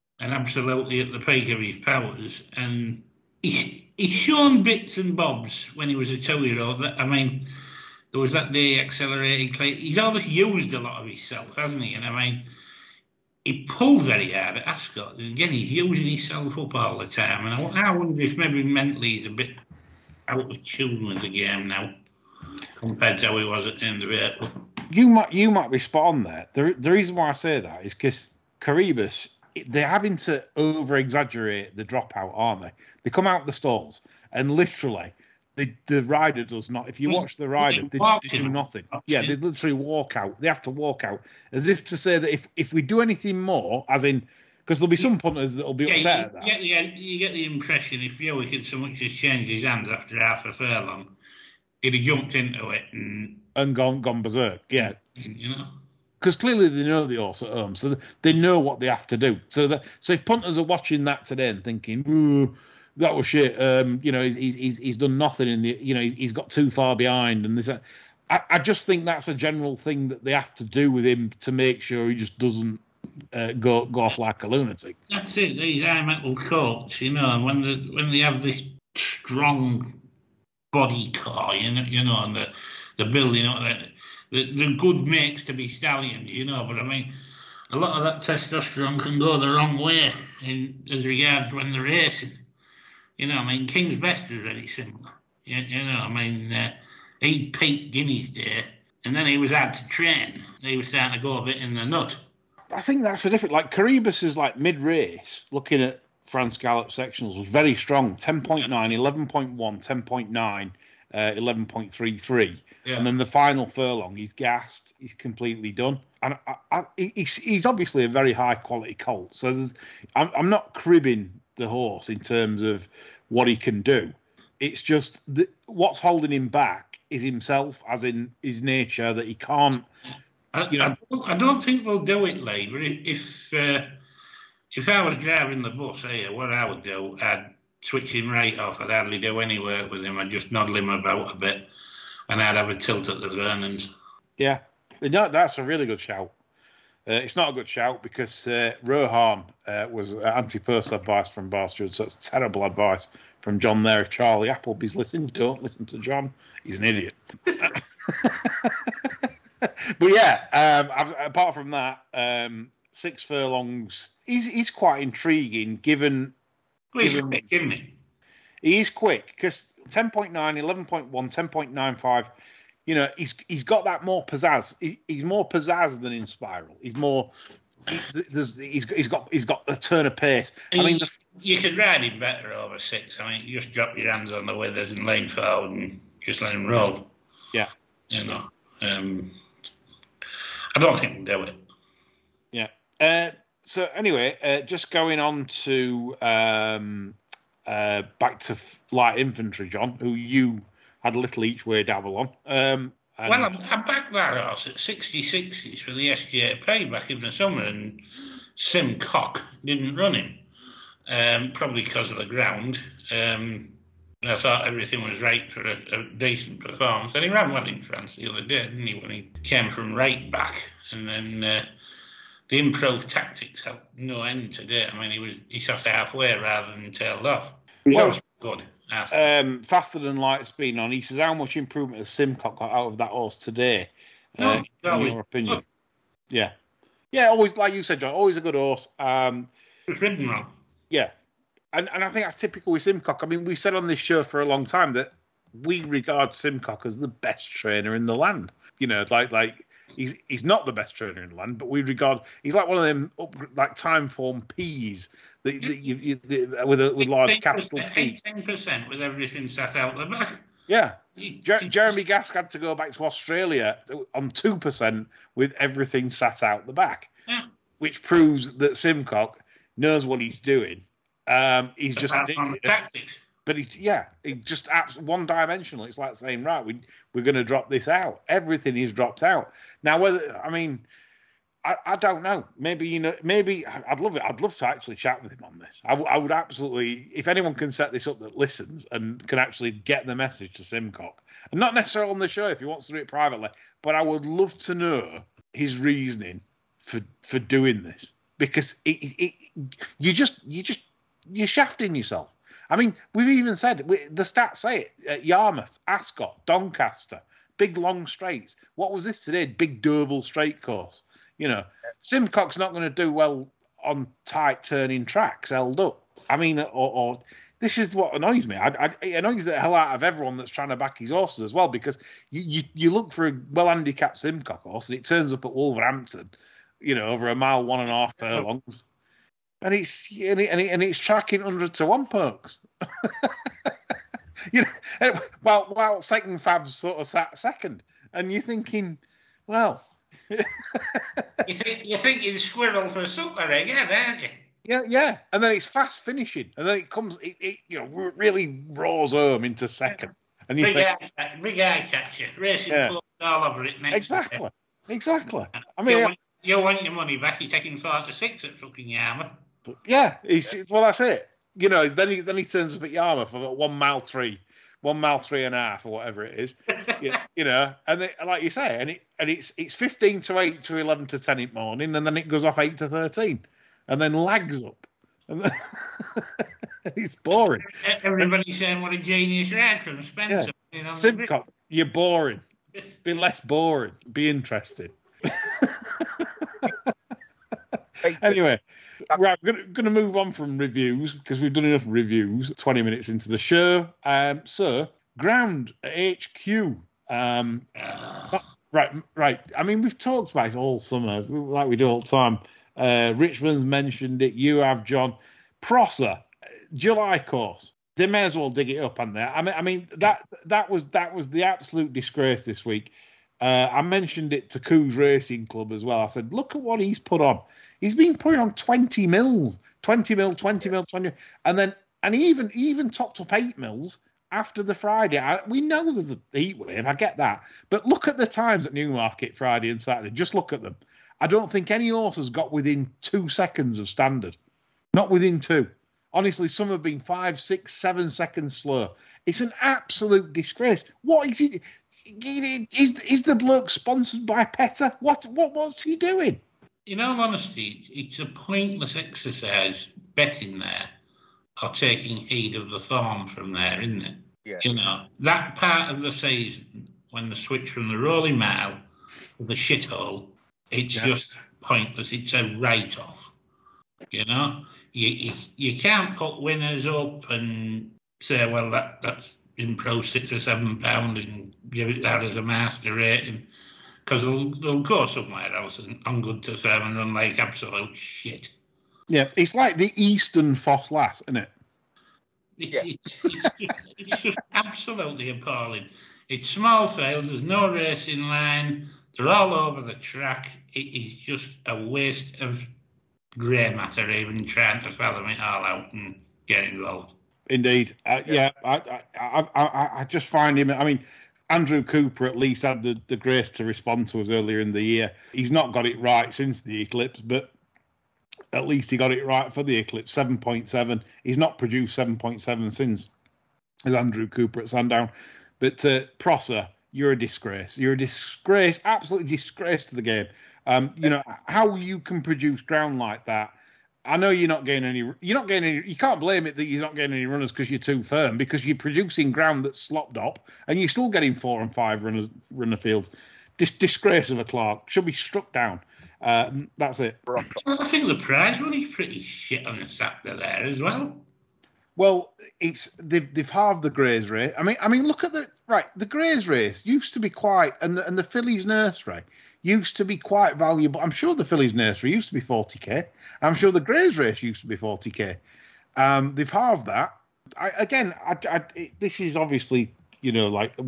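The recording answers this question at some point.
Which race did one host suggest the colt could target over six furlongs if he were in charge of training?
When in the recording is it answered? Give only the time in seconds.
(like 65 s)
143 s.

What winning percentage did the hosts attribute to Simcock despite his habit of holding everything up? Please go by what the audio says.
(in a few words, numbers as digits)
18 percent.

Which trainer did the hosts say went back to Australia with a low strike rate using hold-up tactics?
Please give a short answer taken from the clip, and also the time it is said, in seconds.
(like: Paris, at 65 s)
Jeremy Gask, at 261 s.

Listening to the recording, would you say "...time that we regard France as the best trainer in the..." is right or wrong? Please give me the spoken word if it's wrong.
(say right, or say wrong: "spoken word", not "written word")
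wrong: "Simcock", not "France".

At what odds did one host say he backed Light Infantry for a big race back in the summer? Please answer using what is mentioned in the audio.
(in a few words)
66/1.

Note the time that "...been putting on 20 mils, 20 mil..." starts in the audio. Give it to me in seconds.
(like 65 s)
417 s.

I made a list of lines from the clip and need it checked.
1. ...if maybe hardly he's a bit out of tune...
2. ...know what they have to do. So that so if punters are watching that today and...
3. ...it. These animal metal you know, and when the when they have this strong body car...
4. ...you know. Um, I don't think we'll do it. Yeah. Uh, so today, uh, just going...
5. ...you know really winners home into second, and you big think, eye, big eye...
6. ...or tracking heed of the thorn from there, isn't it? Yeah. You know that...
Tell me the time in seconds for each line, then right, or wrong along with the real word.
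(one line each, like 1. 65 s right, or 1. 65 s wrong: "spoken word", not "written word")
1. 18 s wrong: "mentally", not "hardly"
2. 58 s right
3. 75 s right
4. 188 s wrong: "anyway", not "today"
5. 347 s wrong: "roars", not "winners"
6. 451 s wrong: "taking", not "tracking".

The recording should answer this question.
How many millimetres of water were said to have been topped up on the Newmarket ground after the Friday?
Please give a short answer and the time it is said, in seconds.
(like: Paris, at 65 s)
8 millimetres, at 423 s.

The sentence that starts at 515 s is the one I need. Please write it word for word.
But uh, Prosser, you're a disgrace.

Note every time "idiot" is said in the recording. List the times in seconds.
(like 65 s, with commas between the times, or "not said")
156 s, 272 s.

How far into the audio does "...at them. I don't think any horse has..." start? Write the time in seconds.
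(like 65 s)
430 s.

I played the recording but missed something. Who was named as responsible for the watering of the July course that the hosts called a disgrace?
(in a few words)
John Prosser.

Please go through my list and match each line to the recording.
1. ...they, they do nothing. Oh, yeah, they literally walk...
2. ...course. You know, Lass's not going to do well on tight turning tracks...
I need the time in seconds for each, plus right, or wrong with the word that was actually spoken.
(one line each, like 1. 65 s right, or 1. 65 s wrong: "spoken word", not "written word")
1. 37 s right
2. 310 s wrong: "Simcock", not "Lass".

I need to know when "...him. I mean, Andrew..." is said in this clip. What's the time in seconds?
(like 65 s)
500 s.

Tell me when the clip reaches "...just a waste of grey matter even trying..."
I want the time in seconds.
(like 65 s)
491 s.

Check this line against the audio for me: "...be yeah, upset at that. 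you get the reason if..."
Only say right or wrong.
wrong.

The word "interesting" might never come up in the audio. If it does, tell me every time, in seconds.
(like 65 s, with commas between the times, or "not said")
384 s.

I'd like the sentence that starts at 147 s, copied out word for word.
Uh, it's not a good shout because uh, Rohan uh, was anti-personal advice from Bastard, so it's terrible advice from John there.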